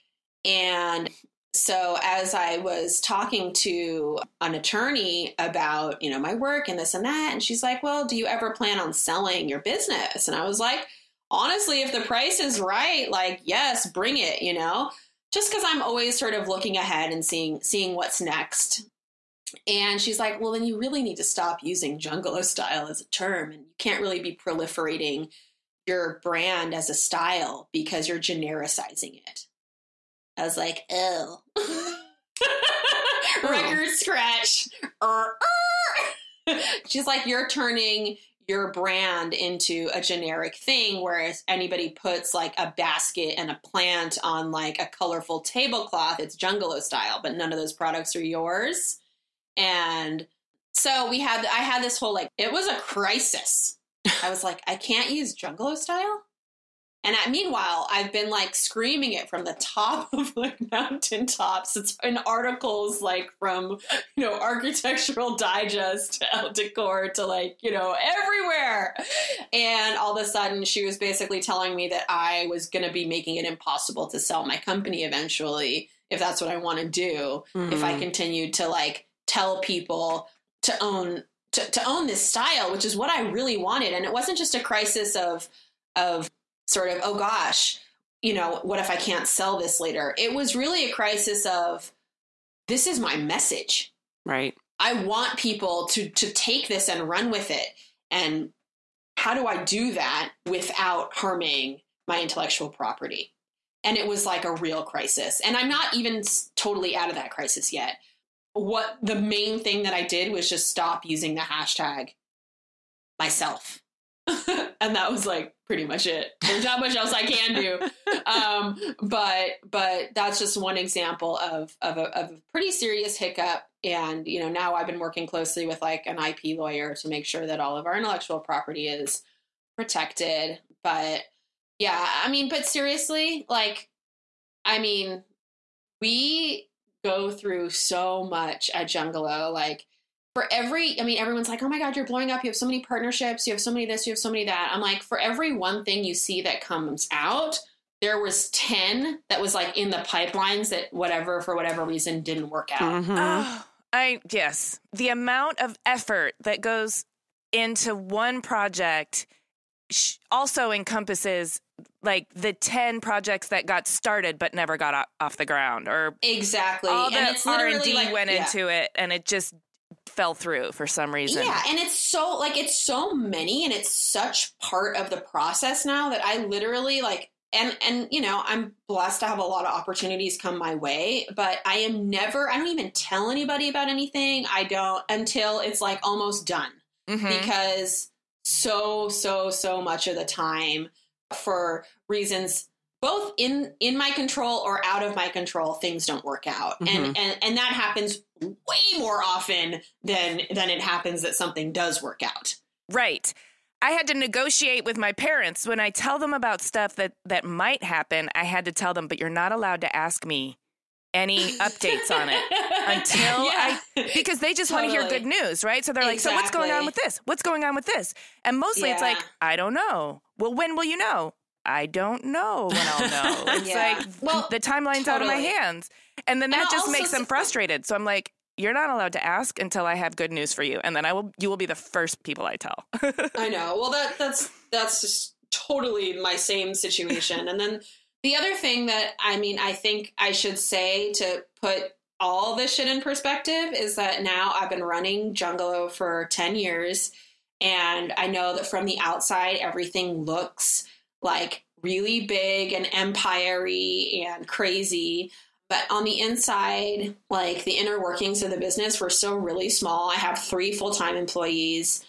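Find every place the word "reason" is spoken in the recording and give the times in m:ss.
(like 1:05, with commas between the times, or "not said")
2:31, 2:51, 3:12.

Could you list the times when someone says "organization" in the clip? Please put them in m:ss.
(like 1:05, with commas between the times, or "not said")
not said.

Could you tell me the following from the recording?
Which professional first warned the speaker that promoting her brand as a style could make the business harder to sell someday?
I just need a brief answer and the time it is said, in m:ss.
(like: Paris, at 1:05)
An attorney, at 0:04.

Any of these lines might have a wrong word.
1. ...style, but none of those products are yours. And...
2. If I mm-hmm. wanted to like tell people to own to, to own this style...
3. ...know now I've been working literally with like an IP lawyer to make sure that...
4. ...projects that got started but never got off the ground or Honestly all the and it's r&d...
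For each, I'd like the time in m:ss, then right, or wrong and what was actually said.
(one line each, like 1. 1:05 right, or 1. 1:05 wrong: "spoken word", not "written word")
1. 0:46 right
2. 1:17 wrong: "continued", not "wanted"
3. 2:04 wrong: "closely", not "literally"
4. 2:43 wrong: "exactly", not "Honestly".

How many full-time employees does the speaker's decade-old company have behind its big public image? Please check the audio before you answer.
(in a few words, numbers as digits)
3.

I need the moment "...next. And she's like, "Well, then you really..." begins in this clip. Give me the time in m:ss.
0:18.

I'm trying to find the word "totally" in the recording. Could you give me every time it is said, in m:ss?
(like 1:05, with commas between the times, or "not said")
1:46, 3:34, 3:45, 3:55.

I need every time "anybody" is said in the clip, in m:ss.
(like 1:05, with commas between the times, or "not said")
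0:41, 3:03.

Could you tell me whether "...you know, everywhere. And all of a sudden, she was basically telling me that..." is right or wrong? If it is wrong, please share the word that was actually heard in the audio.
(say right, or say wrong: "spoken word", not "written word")
right.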